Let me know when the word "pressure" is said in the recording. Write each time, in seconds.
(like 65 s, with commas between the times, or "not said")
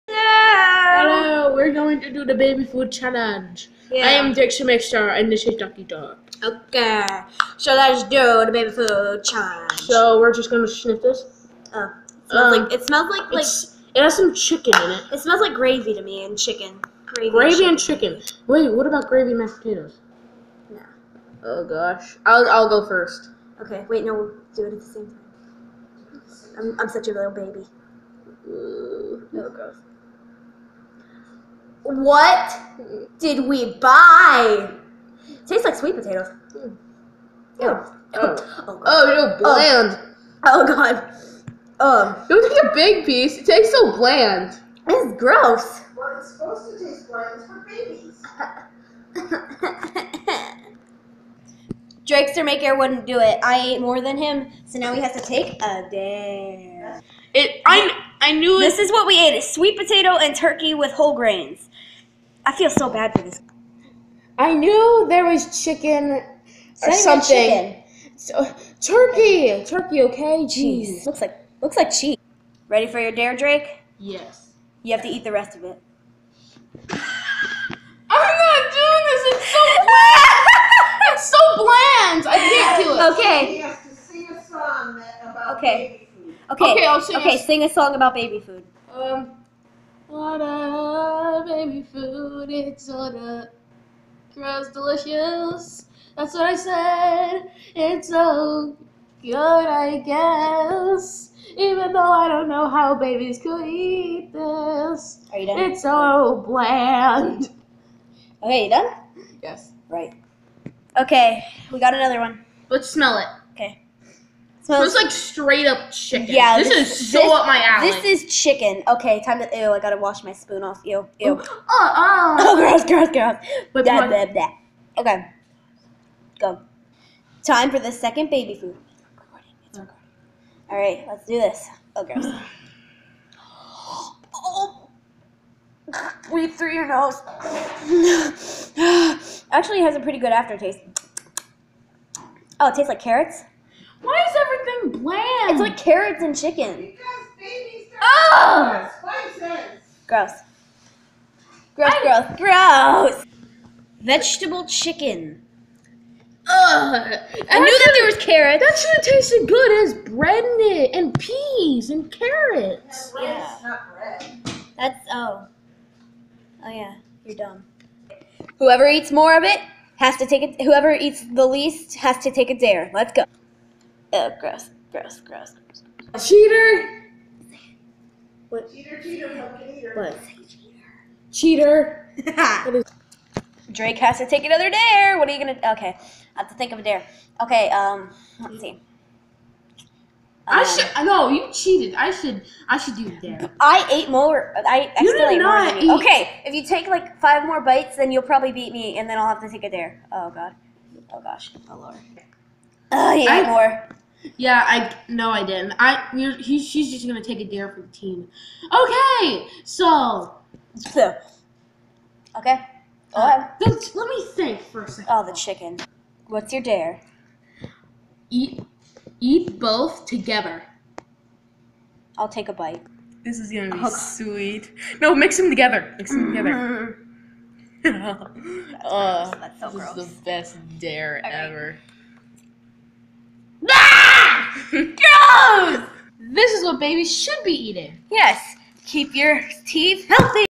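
not said.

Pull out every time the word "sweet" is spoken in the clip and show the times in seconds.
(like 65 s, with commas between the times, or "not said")
35 s, 59 s, 223 s.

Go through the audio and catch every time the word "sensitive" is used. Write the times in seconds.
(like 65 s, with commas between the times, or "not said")
not said.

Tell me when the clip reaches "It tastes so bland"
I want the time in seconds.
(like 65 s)
43 s.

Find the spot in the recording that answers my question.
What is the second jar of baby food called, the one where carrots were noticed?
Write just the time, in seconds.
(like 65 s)
154 s.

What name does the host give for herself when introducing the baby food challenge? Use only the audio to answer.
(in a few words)
Dixie Mixstar.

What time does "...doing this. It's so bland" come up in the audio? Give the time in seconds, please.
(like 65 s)
78 s.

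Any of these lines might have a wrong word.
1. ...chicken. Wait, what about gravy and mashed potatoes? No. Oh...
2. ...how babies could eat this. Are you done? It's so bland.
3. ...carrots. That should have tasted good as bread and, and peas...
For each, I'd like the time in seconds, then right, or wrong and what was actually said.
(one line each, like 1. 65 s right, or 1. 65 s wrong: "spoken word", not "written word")
1. 18 s right
2. 102 s right
3. 158 s right.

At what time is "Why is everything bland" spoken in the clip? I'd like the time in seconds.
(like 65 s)
144 s.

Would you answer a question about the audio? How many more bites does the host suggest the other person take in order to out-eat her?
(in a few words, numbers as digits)
5.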